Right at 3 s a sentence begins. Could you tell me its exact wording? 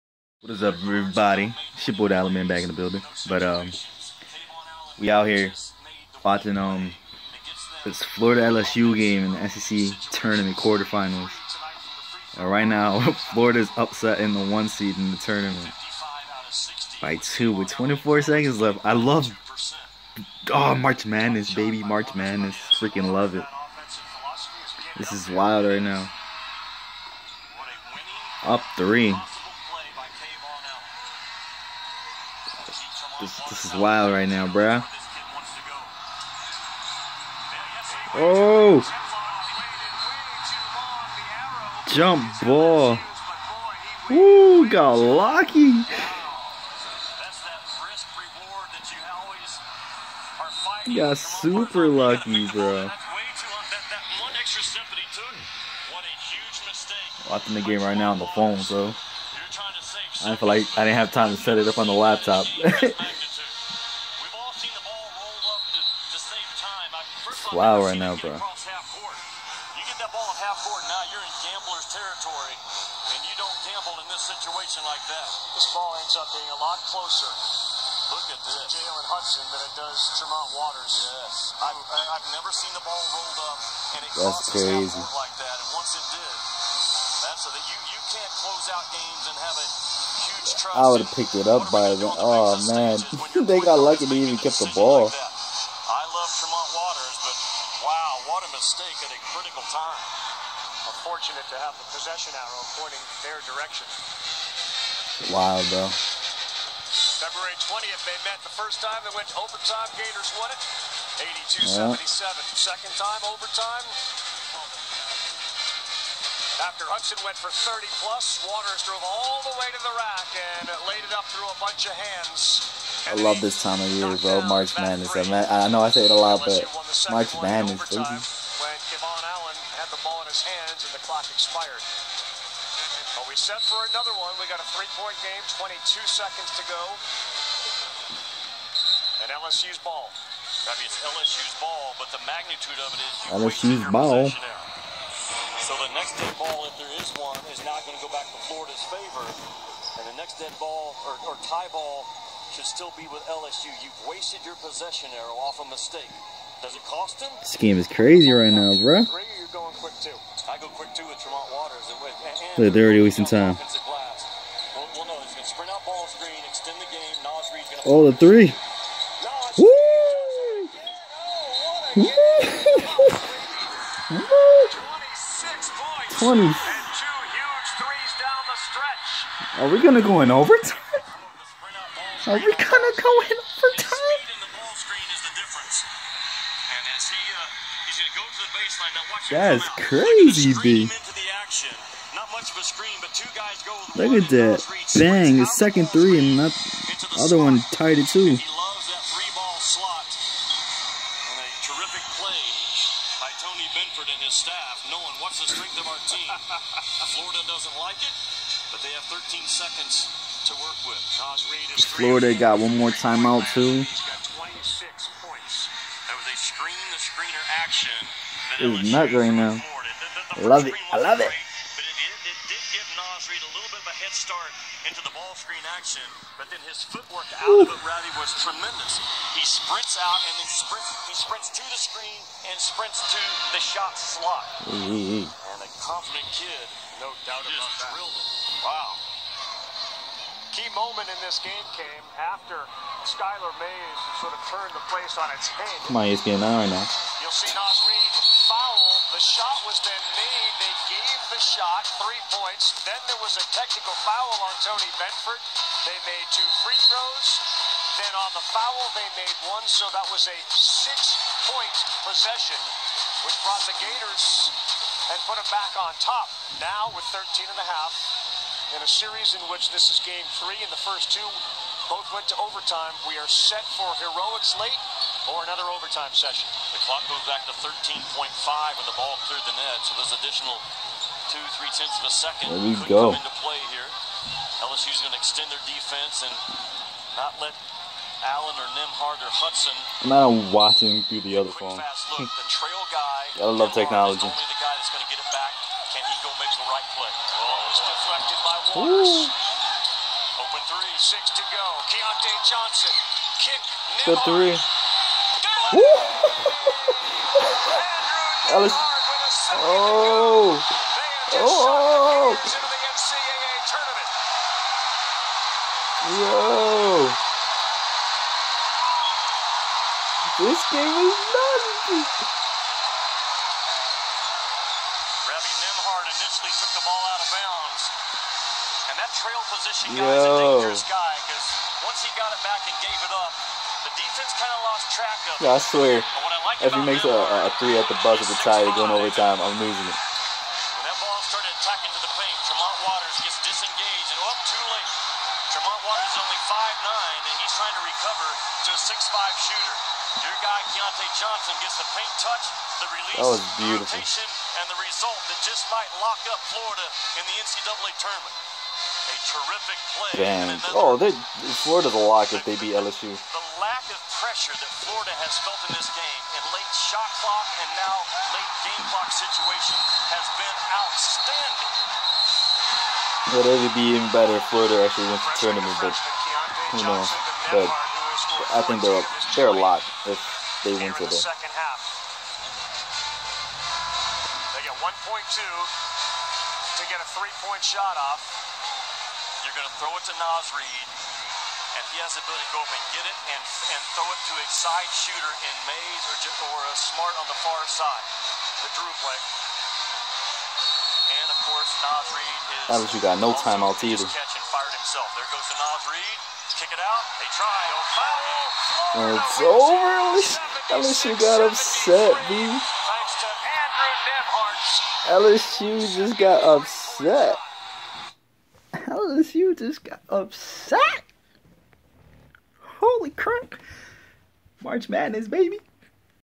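But um, we out here watching um this Florida LSU game in the SEC tournament quarterfinals.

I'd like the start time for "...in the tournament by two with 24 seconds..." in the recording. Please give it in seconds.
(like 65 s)
14 s.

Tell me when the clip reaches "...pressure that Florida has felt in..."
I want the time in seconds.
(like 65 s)
364 s.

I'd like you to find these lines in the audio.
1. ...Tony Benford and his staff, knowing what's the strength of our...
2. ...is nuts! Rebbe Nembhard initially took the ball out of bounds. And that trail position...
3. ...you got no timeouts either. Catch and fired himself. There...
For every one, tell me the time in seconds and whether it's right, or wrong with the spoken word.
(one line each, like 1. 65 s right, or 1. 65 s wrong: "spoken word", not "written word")
1. 203 s right
2. 320 s right
3. 402 s right.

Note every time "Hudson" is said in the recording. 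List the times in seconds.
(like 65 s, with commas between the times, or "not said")
79 s, 116 s, 289 s.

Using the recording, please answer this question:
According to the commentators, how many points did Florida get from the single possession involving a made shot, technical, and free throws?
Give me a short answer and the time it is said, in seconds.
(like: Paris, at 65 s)
6, at 260 s.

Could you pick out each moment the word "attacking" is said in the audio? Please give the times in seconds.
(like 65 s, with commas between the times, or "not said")
341 s.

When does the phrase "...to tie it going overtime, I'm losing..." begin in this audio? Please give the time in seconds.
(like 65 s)
338 s.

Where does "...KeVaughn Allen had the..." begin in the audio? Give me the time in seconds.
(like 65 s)
128 s.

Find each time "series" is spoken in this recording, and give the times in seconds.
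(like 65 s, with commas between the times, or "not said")
268 s.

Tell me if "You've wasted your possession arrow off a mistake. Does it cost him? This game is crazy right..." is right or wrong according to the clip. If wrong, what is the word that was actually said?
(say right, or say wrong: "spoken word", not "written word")
right.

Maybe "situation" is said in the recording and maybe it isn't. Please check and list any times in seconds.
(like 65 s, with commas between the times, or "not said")
74 s, 369 s.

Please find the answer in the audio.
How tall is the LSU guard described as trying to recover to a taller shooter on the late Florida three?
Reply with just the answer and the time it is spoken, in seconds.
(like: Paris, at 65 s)
5'9", at 346 s.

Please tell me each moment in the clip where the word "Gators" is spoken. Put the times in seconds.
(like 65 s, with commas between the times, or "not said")
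109 s, 263 s.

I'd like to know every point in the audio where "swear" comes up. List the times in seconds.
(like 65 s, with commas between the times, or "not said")
335 s.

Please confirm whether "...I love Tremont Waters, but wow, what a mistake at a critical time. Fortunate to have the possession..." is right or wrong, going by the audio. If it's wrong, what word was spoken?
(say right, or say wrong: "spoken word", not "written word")
right.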